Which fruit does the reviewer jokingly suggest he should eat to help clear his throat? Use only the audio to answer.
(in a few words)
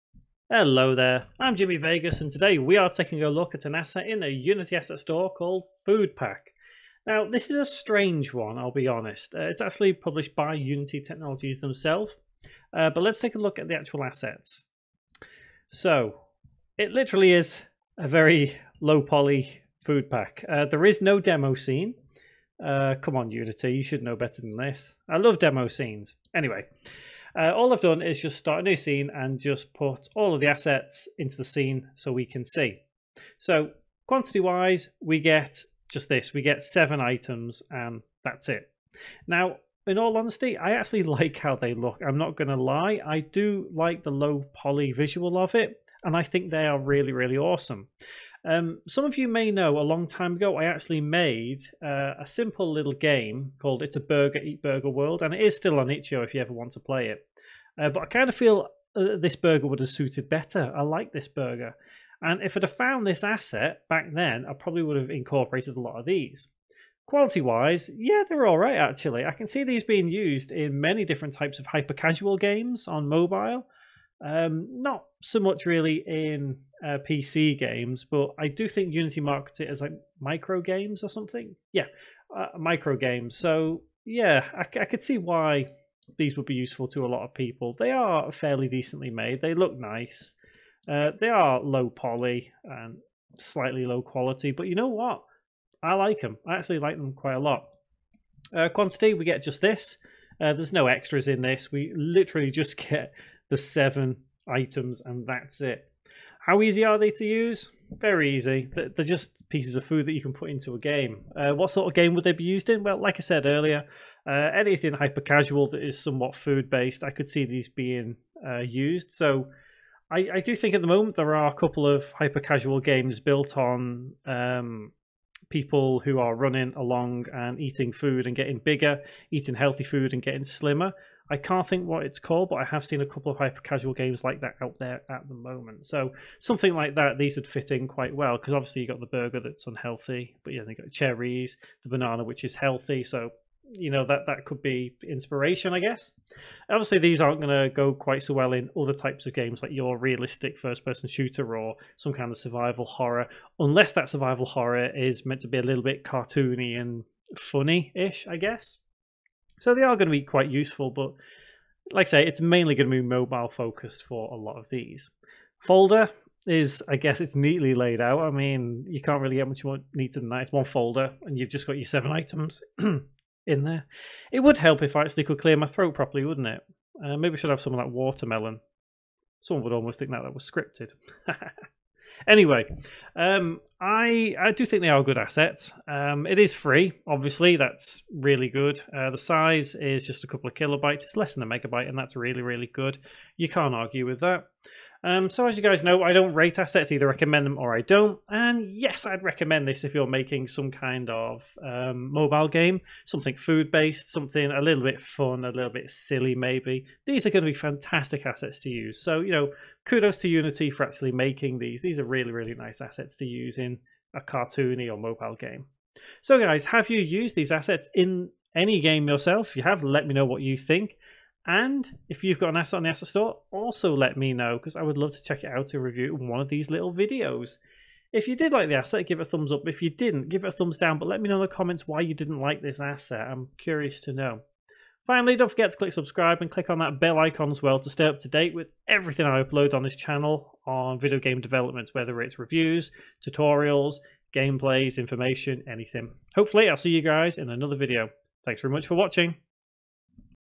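watermelon.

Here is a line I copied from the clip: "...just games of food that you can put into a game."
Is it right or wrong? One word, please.
wrong.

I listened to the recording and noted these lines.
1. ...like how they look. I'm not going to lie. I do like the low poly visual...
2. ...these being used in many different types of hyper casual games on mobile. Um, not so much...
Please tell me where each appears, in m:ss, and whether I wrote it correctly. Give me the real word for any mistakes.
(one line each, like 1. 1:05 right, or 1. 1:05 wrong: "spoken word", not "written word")
1. 0:41 right
2. 1:09 right.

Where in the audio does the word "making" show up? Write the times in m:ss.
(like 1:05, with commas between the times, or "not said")
3:20, 3:31.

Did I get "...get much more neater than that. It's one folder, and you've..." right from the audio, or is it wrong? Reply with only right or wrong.
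right.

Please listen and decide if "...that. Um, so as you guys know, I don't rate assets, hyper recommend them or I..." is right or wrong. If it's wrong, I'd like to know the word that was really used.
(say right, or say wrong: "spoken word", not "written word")
wrong: "either", not "hyper".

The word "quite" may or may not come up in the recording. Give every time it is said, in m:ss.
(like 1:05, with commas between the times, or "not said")
1:37, 2:17, 2:27, 2:40.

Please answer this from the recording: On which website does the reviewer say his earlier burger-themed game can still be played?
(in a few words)
itch.io.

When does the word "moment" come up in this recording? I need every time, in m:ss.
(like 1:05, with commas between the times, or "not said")
2:00, 2:15.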